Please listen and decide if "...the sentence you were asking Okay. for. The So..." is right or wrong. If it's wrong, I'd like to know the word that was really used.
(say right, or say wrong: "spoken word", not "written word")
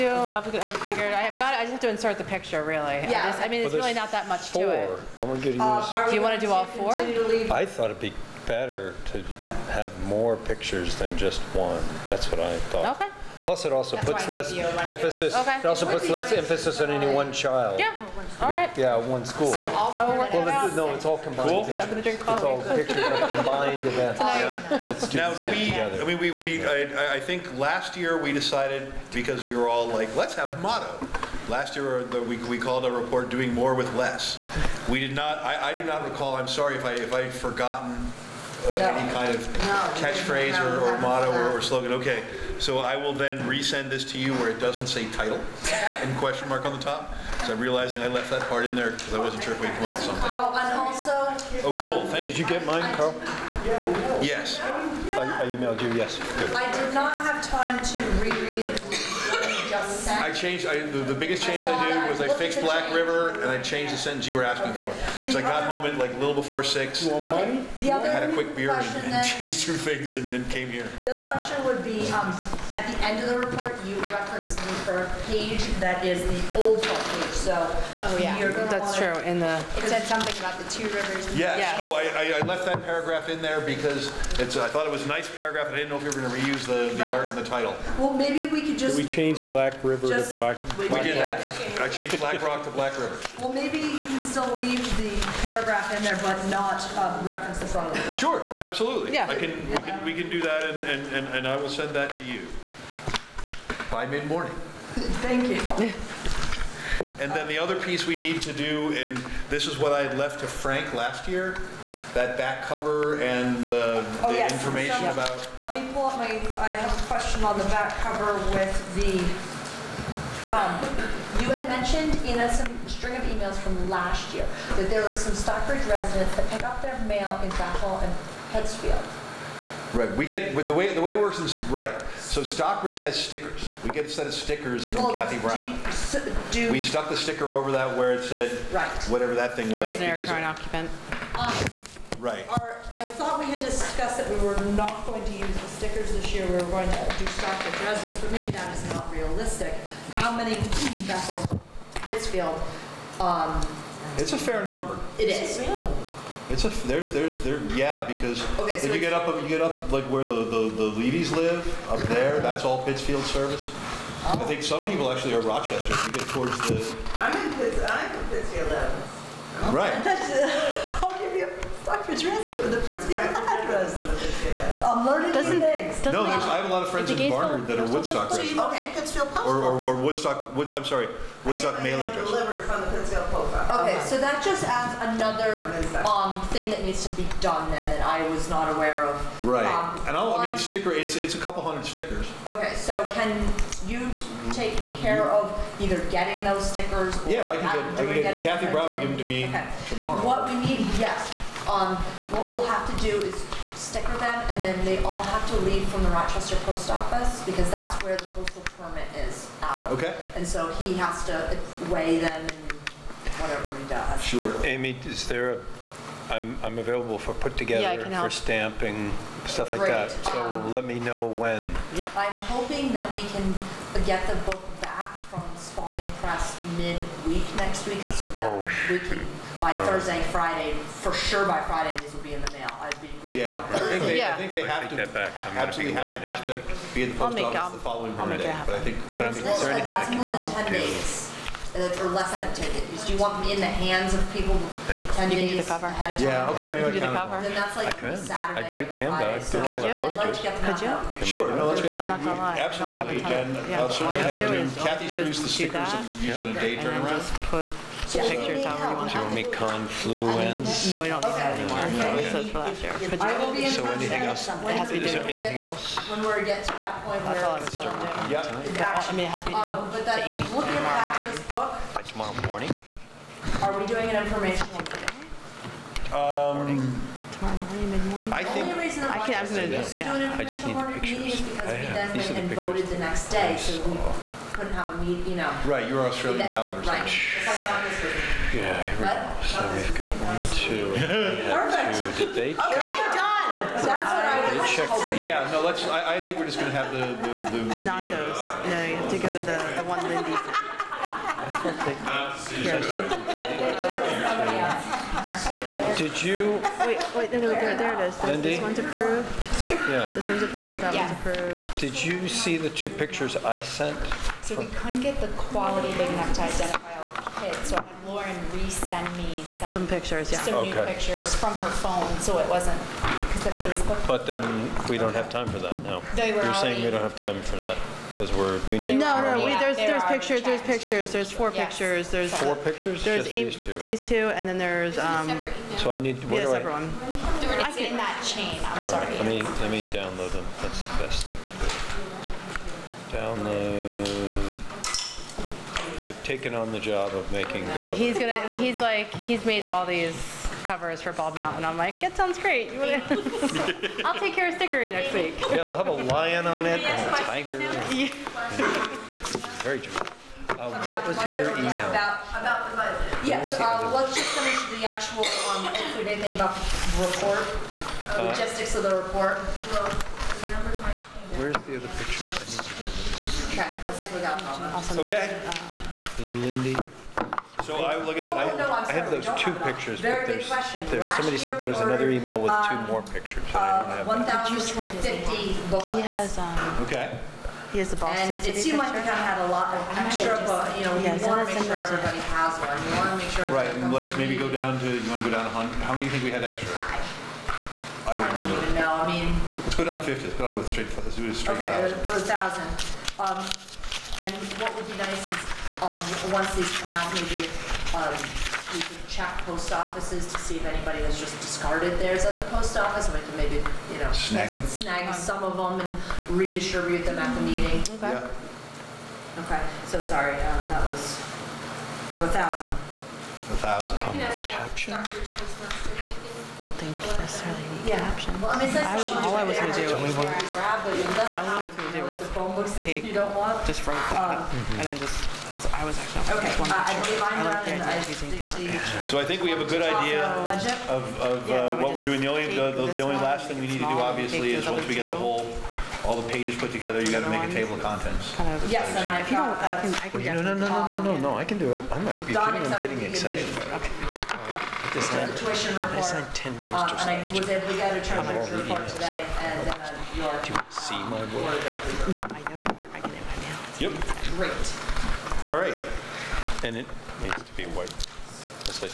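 right.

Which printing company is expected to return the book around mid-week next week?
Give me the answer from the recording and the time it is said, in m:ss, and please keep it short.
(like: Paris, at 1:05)
Spalding Press, at 3:45.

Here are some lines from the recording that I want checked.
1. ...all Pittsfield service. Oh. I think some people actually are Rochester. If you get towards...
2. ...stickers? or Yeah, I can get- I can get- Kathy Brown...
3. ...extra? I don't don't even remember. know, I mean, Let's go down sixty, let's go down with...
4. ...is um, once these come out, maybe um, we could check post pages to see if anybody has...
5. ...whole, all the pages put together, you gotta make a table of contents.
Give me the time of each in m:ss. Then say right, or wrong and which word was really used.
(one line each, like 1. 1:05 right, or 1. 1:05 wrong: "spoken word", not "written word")
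1. 2:42 right
2. 3:16 right
3. 6:36 wrong: "fifty", not "sixty"
4. 6:45 wrong: "offices", not "pages"
5. 7:25 right.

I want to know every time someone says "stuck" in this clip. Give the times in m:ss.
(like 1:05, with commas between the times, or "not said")
2:16.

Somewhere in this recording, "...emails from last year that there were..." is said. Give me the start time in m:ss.
2:03.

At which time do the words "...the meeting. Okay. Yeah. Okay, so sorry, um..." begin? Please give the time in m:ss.
6:57.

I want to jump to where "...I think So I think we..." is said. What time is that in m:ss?
7:17.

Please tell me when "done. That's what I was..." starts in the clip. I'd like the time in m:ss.
4:53.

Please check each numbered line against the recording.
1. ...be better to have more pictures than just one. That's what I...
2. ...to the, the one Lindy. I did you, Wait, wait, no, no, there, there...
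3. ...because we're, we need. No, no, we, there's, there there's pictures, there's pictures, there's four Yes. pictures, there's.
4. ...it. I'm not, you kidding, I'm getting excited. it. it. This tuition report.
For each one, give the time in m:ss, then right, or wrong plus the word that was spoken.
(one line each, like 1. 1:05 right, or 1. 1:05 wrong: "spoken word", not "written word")
1. 0:07 right
2. 4:59 right
3. 5:28 right
4. 7:31 right.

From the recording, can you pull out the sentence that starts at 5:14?
So we couldn't get the quality big enough to identify all the kids, so I had Lauren resend me some.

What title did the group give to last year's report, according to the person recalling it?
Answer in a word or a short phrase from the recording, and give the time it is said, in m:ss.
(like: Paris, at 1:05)
Doing more with less, at 0:33.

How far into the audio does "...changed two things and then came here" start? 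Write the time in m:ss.
1:09.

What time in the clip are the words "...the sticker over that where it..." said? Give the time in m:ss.
2:17.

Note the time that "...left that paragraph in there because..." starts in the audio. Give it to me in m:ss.
1:22.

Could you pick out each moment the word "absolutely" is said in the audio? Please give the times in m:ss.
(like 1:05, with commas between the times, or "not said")
1:38, 3:55, 4:12.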